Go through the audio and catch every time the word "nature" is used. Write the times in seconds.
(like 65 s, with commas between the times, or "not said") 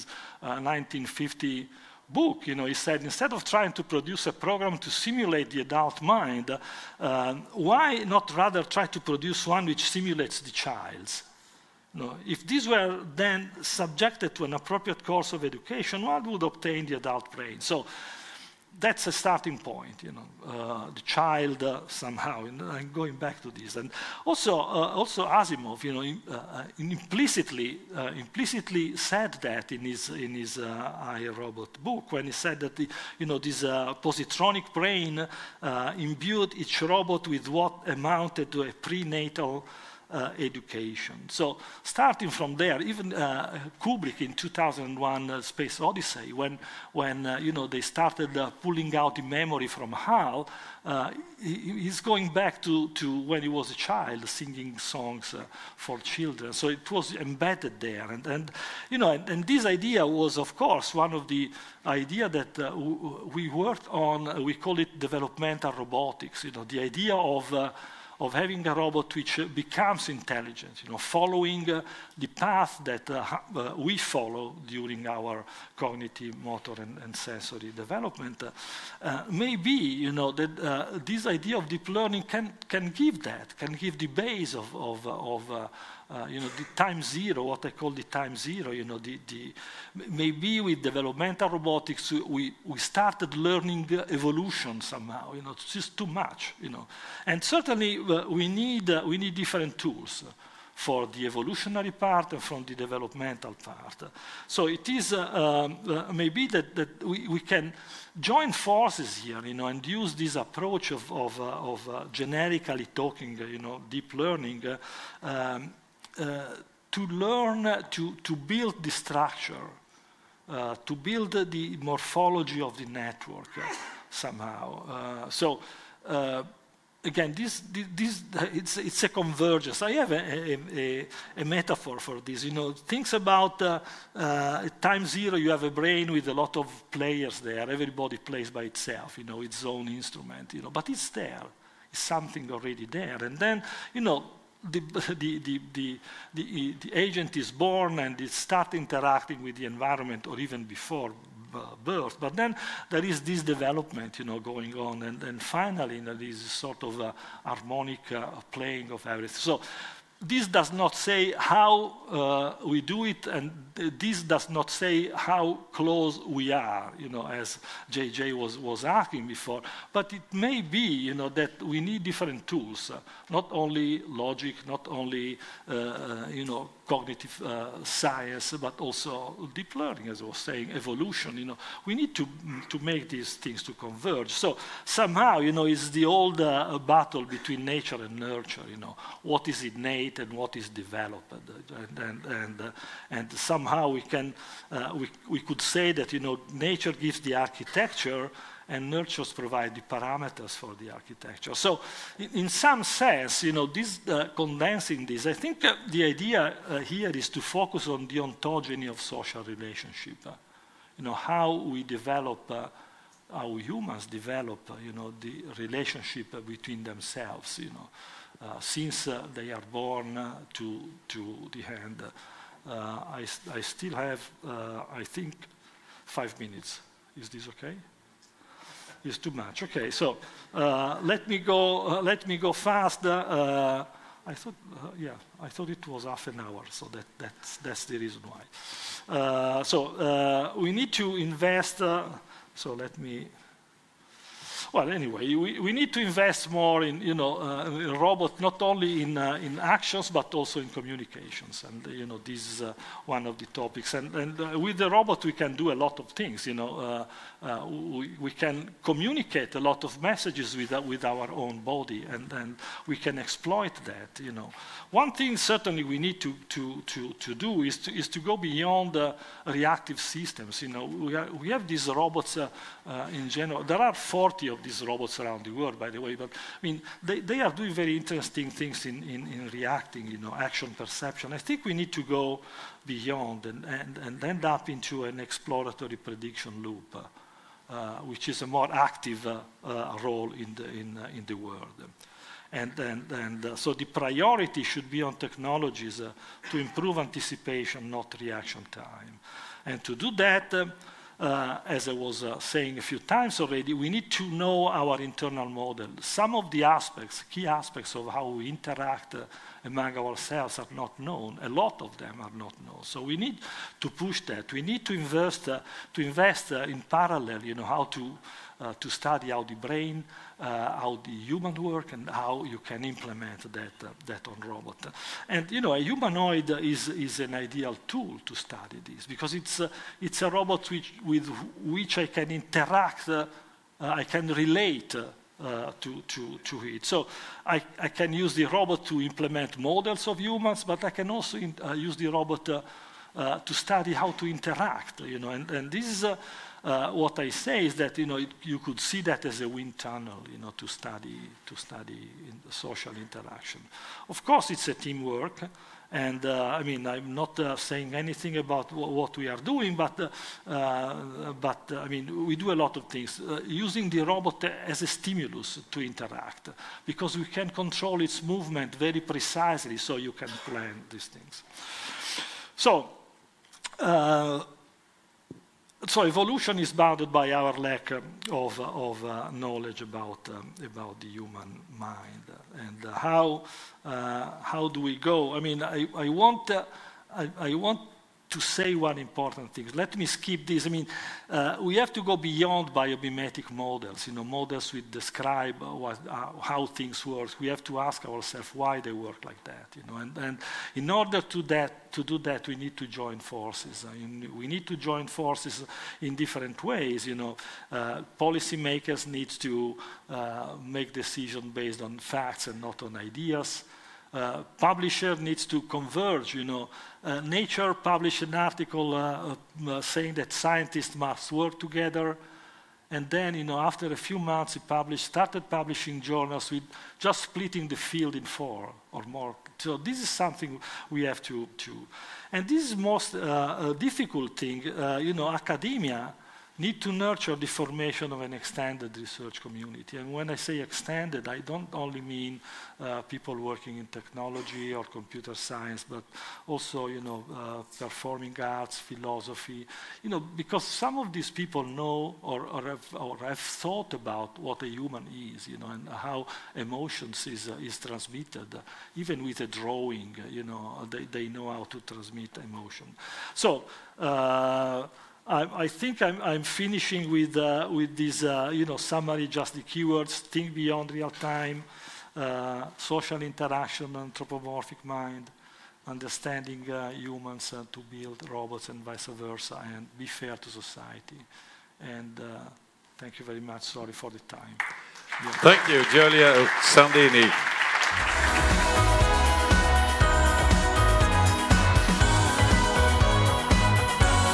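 187 s, 196 s, 417 s.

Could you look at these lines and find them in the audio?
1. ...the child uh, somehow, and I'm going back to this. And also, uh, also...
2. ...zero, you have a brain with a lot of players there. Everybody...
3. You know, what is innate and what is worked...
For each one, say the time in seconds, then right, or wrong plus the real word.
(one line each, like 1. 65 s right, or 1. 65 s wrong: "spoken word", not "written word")
1. 20 s right
2. 135 s right
3. 188 s wrong: "developed", not "worked".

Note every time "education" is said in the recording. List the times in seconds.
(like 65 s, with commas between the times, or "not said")
15 s, 40 s.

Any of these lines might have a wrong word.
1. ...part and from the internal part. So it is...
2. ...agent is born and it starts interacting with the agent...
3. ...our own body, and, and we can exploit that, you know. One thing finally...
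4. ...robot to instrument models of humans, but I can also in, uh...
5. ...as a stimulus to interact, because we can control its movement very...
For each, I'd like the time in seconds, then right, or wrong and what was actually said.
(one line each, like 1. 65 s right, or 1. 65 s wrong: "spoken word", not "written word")
1. 101 s wrong: "developmental", not "internal"
2. 146 s wrong: "environment", not "agent"
3. 261 s wrong: "certainly", not "finally"
4. 338 s wrong: "implement", not "instrument"
5. 364 s right.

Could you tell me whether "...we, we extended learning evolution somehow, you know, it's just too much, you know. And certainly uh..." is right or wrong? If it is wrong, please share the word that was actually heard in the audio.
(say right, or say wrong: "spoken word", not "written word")
wrong: "started", not "extended".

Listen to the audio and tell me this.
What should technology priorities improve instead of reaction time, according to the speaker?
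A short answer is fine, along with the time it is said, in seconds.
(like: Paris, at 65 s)
anticipation, at 296 s.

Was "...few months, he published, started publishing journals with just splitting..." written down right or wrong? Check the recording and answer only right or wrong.
right.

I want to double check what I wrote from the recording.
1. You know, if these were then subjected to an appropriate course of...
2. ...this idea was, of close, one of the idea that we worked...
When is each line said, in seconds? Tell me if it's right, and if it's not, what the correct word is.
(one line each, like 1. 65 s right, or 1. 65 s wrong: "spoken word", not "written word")
1. 11 s right
2. 59 s wrong: "course", not "close".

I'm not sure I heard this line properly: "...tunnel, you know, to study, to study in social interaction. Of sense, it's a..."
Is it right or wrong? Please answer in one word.
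wrong.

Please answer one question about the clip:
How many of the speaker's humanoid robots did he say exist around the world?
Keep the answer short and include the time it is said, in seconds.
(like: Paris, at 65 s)
40, at 273 s.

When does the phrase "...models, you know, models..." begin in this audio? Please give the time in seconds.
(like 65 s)
393 s.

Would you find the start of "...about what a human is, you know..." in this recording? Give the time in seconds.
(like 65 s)
453 s.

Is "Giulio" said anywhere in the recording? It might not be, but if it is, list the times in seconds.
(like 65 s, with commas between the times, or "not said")
485 s.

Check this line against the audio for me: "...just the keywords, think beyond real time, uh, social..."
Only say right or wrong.
right.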